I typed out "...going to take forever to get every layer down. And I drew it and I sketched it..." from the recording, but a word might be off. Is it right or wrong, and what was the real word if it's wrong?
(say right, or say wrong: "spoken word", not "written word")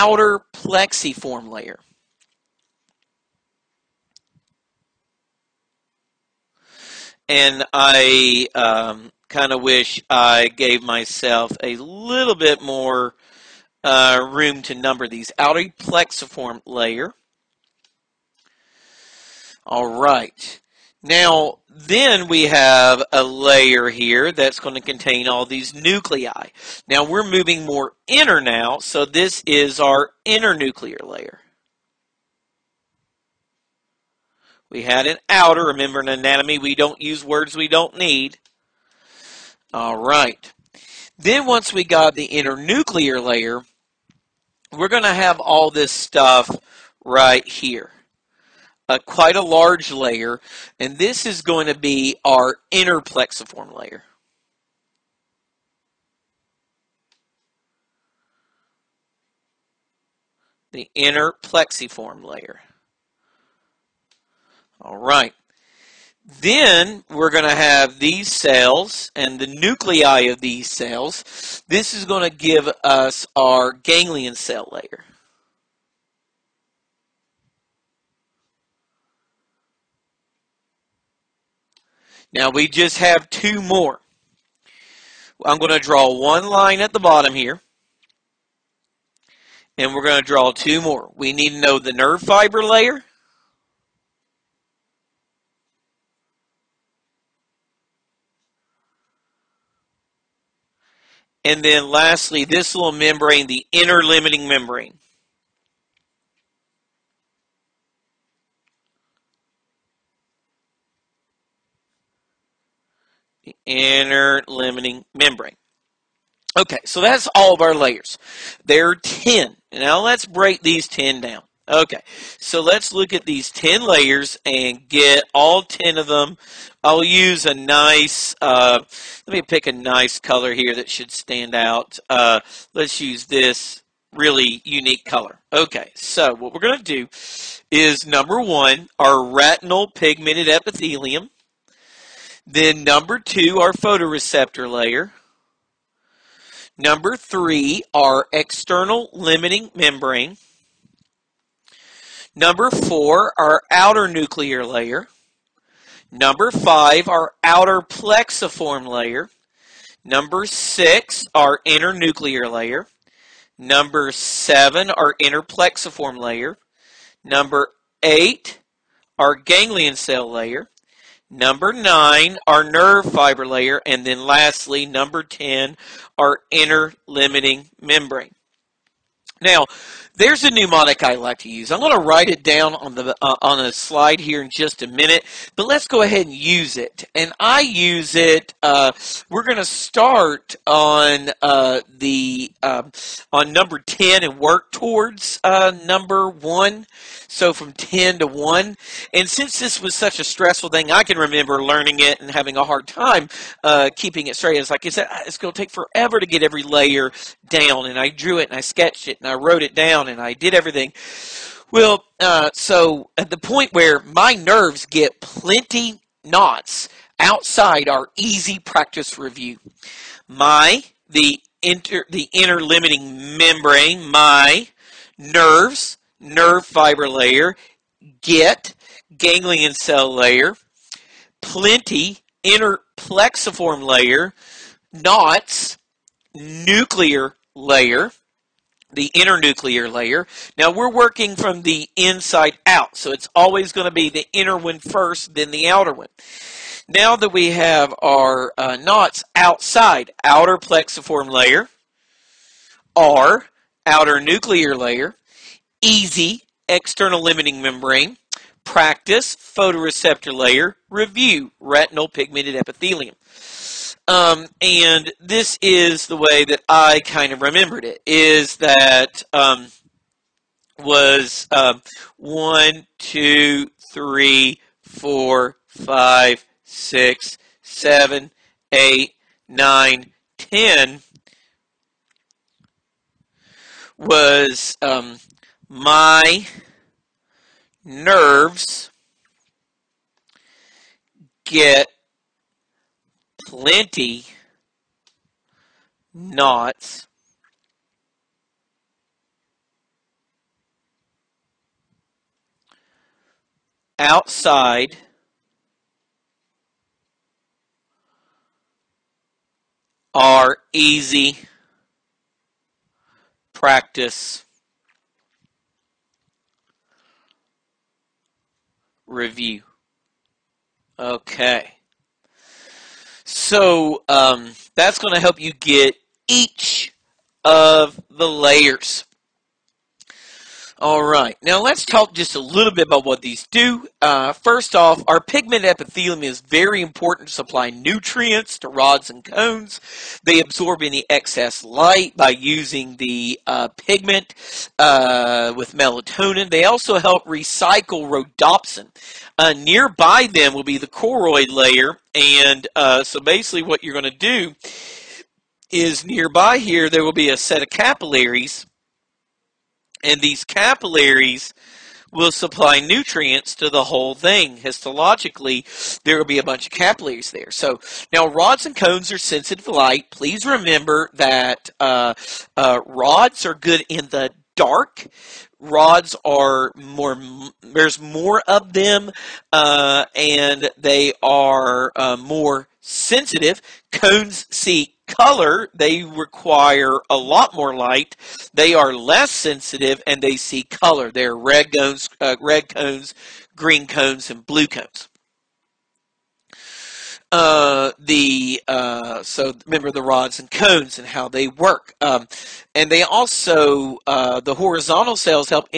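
right.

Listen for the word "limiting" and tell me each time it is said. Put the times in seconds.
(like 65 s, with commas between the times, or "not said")
104 s, 114 s, 149 s, 177 s, 222 s, 257 s.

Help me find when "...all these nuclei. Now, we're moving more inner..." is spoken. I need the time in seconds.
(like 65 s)
25 s.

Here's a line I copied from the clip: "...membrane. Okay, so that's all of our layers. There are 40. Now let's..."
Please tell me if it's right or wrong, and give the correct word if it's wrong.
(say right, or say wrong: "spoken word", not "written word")
wrong: "10", not "40".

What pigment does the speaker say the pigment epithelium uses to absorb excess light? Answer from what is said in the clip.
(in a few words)
melatonin.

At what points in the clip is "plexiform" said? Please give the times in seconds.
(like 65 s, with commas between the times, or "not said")
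0 s, 15 s, 52 s, 61 s, 157 s, 165 s, 232 s, 250 s.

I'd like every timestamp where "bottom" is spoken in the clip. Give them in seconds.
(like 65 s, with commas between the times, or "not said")
87 s.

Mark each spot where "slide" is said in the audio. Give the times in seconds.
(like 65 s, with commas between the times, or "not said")
183 s.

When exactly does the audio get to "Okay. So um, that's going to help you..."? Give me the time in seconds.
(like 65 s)
320 s.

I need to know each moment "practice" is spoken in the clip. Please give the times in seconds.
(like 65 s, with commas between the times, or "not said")
218 s, 258 s, 313 s.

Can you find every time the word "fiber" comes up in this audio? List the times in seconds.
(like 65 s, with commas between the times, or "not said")
92 s, 173 s, 226 s.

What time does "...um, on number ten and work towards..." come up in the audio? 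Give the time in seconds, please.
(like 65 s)
192 s.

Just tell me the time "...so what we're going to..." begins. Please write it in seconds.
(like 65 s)
135 s.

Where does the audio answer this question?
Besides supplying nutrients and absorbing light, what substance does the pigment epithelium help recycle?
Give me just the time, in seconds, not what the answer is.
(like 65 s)
348 s.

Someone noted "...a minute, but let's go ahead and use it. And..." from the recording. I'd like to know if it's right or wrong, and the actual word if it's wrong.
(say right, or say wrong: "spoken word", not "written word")
right.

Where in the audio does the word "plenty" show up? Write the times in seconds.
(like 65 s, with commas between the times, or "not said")
215 s, 231 s, 293 s.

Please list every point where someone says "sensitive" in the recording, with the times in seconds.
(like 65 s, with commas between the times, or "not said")
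369 s, 382 s, 389 s.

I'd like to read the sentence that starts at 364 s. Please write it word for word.
Histologically, there will be a bunch of capillaries there.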